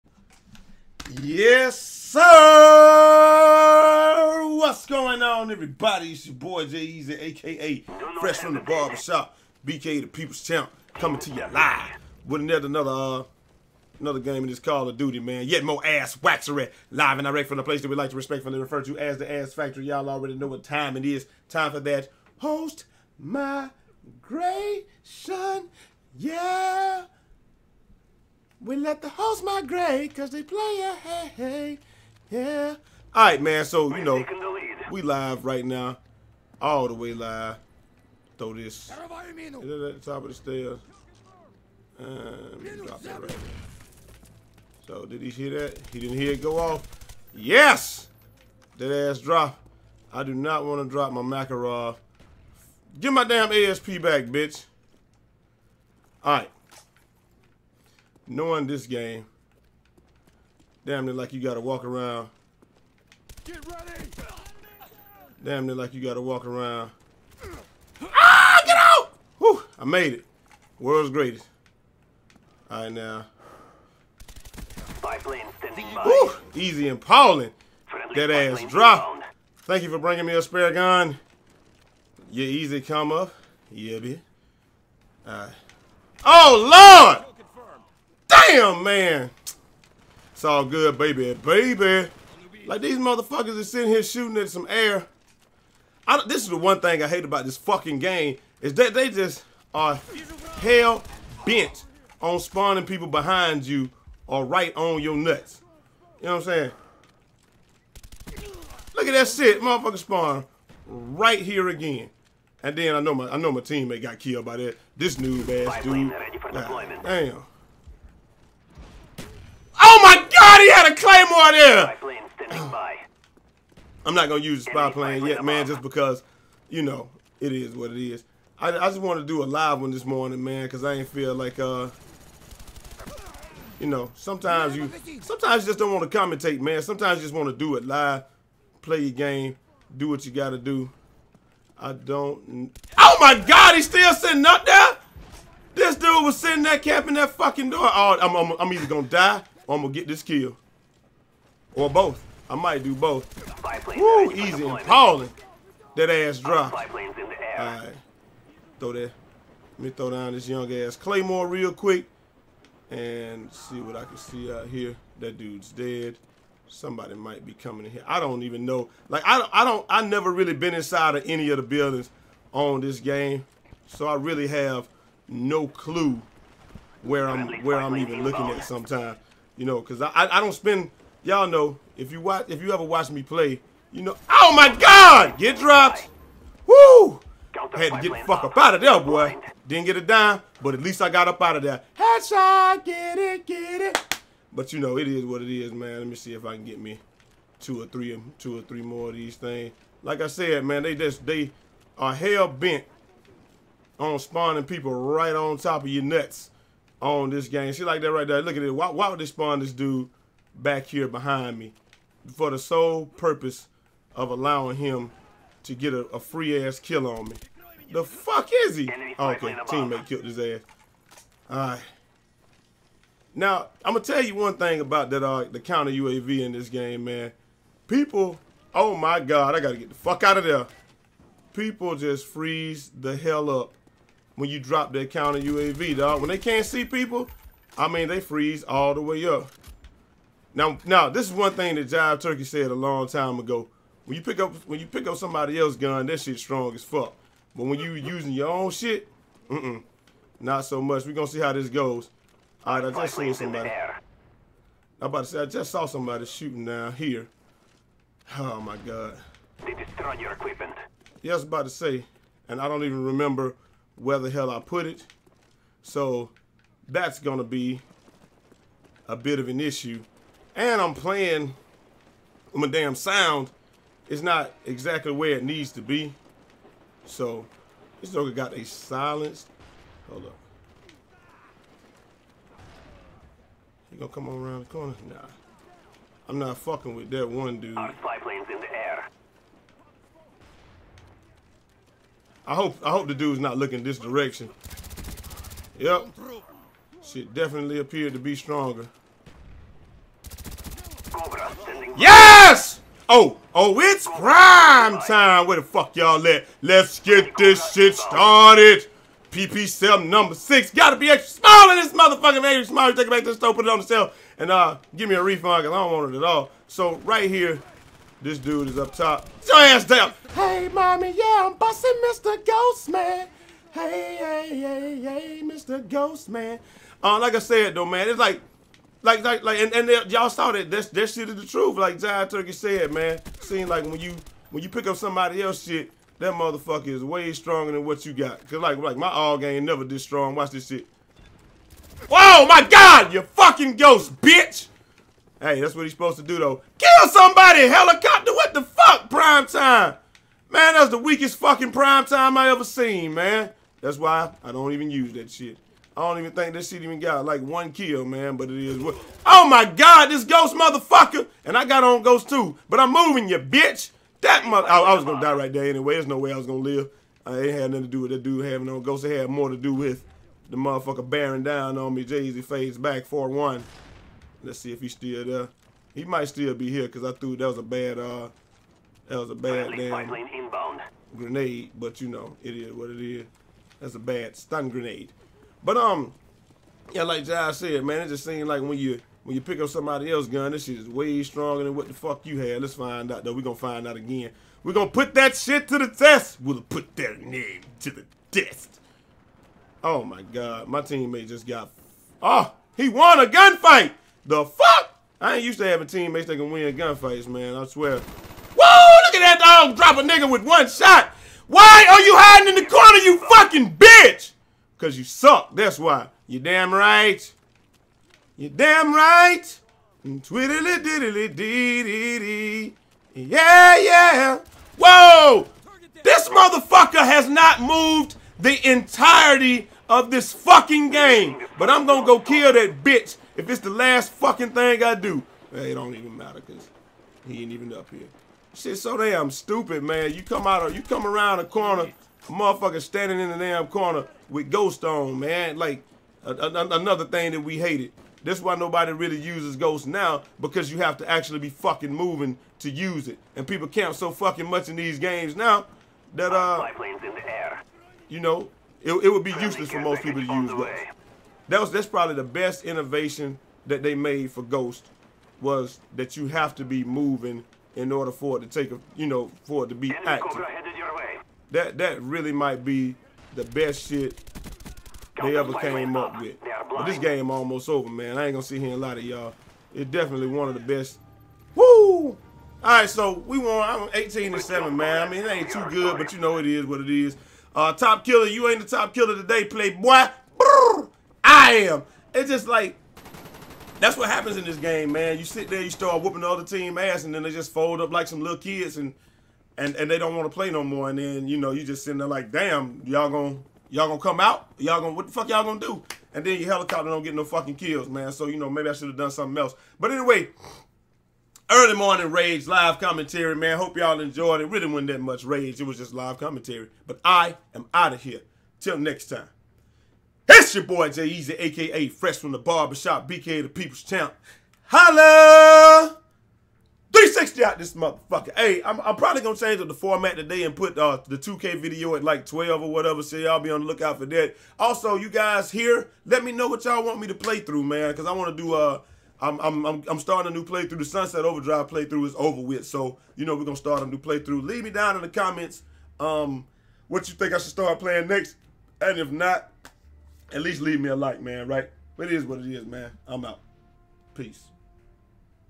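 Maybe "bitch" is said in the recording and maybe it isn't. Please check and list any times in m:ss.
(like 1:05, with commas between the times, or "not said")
0:54, 5:44, 6:03, 6:53, 7:12.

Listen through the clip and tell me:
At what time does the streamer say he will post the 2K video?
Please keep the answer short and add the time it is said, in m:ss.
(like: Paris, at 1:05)
12, at 8:52.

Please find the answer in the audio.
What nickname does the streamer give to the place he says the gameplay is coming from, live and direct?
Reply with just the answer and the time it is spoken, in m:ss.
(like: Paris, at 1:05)
the Ass Factory, at 0:19.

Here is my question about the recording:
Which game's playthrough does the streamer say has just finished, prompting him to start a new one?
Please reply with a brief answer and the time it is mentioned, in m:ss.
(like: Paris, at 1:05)
Sunset Overdrive, at 9:00.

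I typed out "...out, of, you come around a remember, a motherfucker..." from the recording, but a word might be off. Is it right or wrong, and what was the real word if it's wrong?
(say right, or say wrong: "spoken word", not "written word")
wrong: "corner", not "remember".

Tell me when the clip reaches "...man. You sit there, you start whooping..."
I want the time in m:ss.
8:14.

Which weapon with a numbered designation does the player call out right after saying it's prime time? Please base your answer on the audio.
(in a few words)
PP 7.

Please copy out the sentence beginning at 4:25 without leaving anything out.
So that's going to be a bit of an issue.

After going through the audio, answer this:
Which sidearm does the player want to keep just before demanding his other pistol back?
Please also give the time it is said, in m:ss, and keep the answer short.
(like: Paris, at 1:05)
Makarov, at 0:51.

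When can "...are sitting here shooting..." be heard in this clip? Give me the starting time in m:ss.
1:33.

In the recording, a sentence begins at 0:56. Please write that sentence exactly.
All right knowing this game, damn it, like you gotta walk around.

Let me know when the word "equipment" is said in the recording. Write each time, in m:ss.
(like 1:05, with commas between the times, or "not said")
4:20.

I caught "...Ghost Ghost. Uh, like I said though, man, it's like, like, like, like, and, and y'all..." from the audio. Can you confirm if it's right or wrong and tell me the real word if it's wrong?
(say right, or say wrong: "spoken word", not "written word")
wrong: "Man", not "Ghost".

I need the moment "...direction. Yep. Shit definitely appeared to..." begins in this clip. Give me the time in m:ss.
4:53.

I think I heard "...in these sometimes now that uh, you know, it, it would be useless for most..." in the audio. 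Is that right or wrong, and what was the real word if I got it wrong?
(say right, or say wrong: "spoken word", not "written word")
wrong: "games", not "sometimes".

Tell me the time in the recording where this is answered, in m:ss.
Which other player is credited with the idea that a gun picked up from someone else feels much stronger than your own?
4:01.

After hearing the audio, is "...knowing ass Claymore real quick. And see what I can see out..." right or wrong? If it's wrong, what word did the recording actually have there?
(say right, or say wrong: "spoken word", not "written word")
wrong: "young", not "knowing".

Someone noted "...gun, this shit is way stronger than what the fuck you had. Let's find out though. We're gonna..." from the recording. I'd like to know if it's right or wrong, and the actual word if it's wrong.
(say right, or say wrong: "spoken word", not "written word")
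right.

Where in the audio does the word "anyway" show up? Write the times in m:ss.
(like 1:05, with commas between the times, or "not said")
6:05, 8:29.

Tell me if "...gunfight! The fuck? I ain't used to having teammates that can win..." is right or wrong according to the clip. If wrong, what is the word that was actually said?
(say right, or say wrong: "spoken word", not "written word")
right.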